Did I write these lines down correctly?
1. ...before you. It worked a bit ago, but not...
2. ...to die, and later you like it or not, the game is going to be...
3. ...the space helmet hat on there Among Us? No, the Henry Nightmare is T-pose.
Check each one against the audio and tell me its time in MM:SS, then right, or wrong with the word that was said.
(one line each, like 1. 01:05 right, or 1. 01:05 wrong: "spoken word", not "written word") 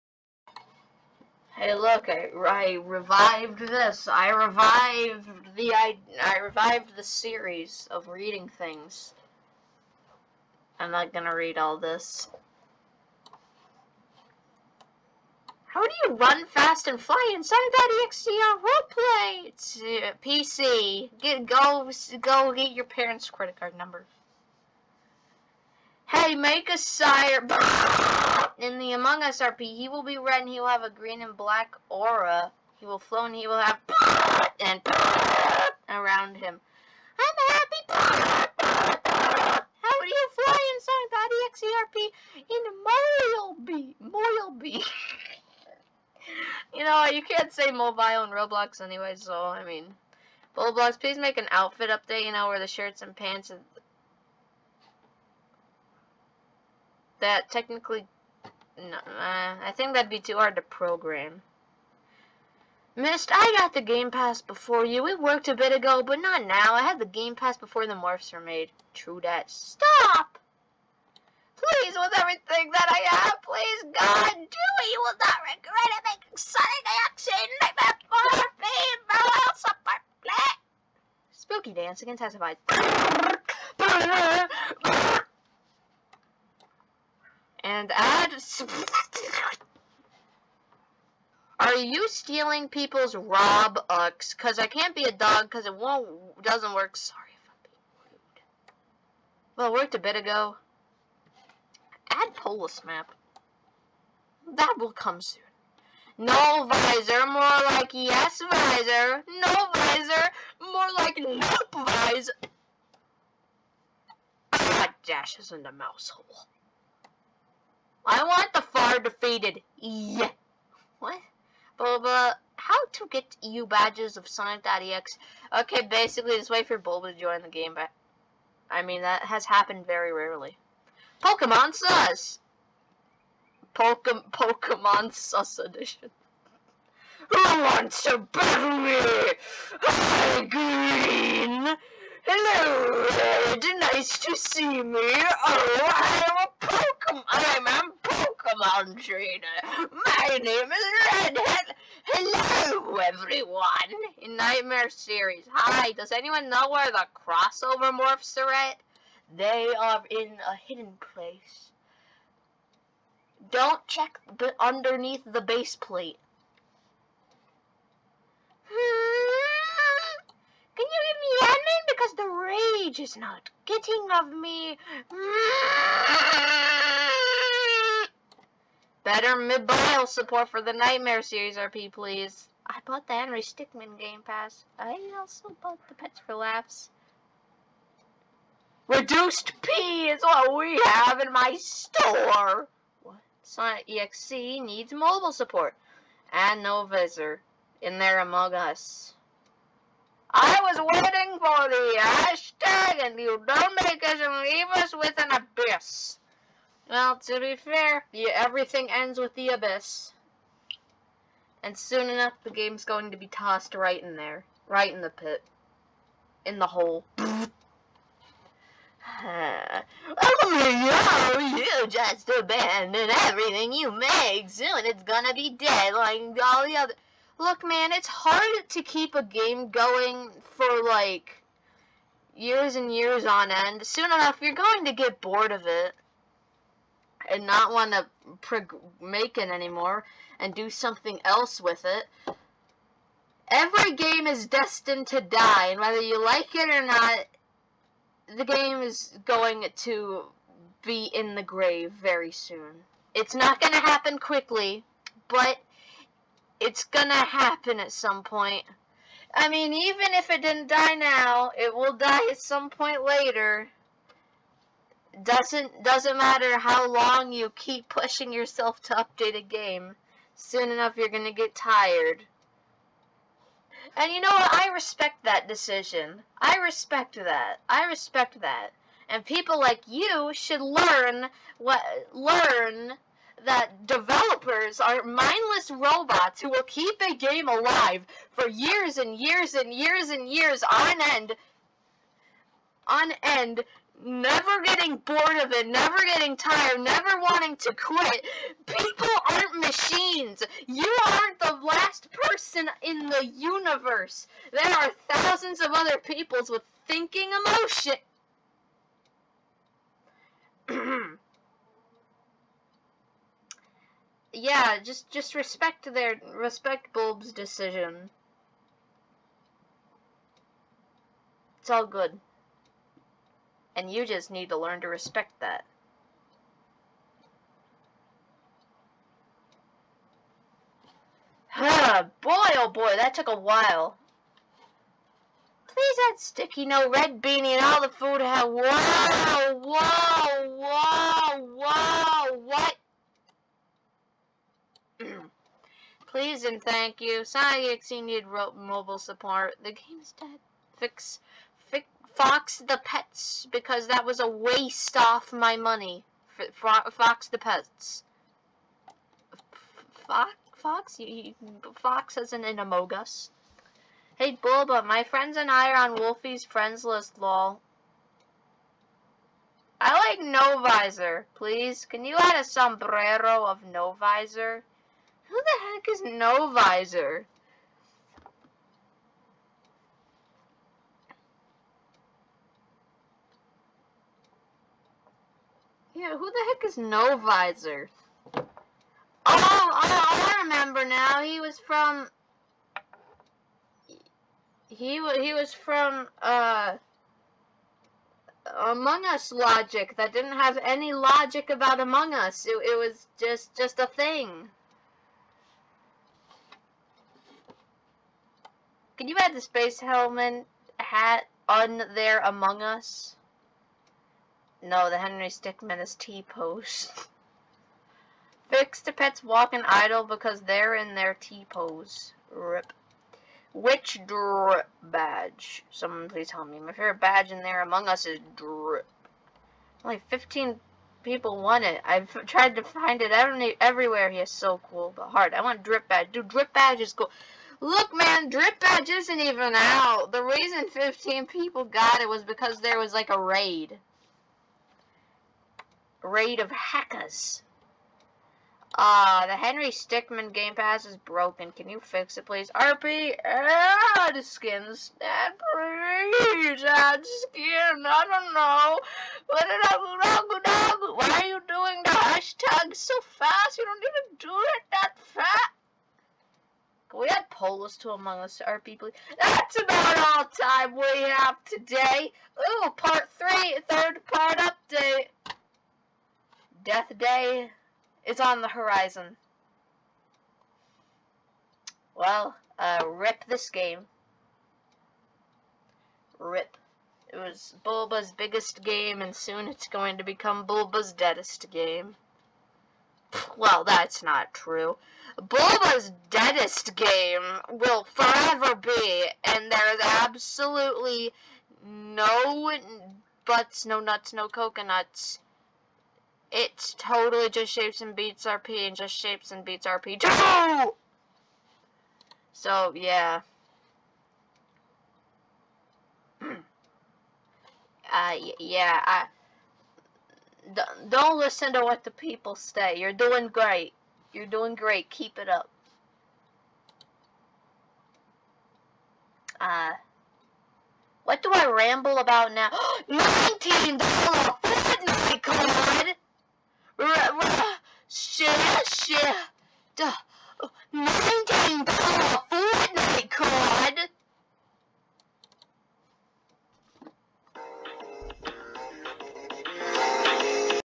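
1. 01:04 right
2. 04:05 wrong: "whether", not "later"
3. 06:49 wrong: "Stickmin", not "Nightmare".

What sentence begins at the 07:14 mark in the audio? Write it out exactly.
He is so cool, but hard.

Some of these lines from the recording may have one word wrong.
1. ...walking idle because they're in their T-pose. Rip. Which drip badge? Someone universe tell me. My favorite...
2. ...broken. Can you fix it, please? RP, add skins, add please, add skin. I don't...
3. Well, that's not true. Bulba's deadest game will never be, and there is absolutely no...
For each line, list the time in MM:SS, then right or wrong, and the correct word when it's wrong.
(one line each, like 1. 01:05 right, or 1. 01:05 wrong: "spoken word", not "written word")
1. 06:59 wrong: "please", not "universe"
2. 07:30 right
3. 08:13 wrong: "forever", not "never".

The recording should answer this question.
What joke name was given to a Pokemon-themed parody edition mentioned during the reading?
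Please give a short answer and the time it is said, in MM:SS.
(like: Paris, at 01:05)
Pokemon Sus Edition, at 02:14.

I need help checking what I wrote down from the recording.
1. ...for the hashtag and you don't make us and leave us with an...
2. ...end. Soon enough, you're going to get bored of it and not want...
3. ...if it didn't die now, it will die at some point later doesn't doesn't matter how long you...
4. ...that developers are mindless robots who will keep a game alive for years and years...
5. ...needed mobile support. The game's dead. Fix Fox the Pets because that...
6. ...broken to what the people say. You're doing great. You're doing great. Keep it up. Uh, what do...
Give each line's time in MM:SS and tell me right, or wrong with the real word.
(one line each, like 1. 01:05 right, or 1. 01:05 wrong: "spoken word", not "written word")
1. 03:21 right
2. 03:53 right
3. 04:20 right
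4. 04:43 right
5. 05:48 right
6. 08:41 wrong: "listen", not "broken".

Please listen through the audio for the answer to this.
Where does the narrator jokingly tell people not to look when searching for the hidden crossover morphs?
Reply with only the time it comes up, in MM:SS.
02:44.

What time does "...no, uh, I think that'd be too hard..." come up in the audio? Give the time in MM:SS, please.
00:58.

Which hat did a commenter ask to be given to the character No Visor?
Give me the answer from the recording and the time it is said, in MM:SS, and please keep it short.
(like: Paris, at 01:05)
A sombrero, at 06:12.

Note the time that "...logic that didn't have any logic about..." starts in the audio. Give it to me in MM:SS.
06:39.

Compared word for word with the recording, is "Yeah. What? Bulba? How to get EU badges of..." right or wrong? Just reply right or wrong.
right.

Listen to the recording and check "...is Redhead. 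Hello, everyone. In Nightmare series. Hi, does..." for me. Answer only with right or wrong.
right.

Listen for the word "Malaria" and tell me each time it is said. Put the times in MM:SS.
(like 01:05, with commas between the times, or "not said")
not said.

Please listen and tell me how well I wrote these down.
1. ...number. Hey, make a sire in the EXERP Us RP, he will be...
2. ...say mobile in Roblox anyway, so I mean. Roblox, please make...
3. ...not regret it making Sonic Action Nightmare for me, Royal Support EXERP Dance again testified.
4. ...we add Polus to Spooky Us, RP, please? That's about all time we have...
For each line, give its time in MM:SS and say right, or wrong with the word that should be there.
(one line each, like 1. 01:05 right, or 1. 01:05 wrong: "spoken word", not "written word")
1. 00:23 wrong: "Among", not "EXERP"
2. 00:47 right
3. 01:15 wrong: "Spooky", not "EXERP"
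4. 07:47 wrong: "Among", not "Spooky".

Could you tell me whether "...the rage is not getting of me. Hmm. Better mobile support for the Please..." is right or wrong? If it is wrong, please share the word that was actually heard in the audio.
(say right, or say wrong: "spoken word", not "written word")
wrong: "Nightmare", not "Please".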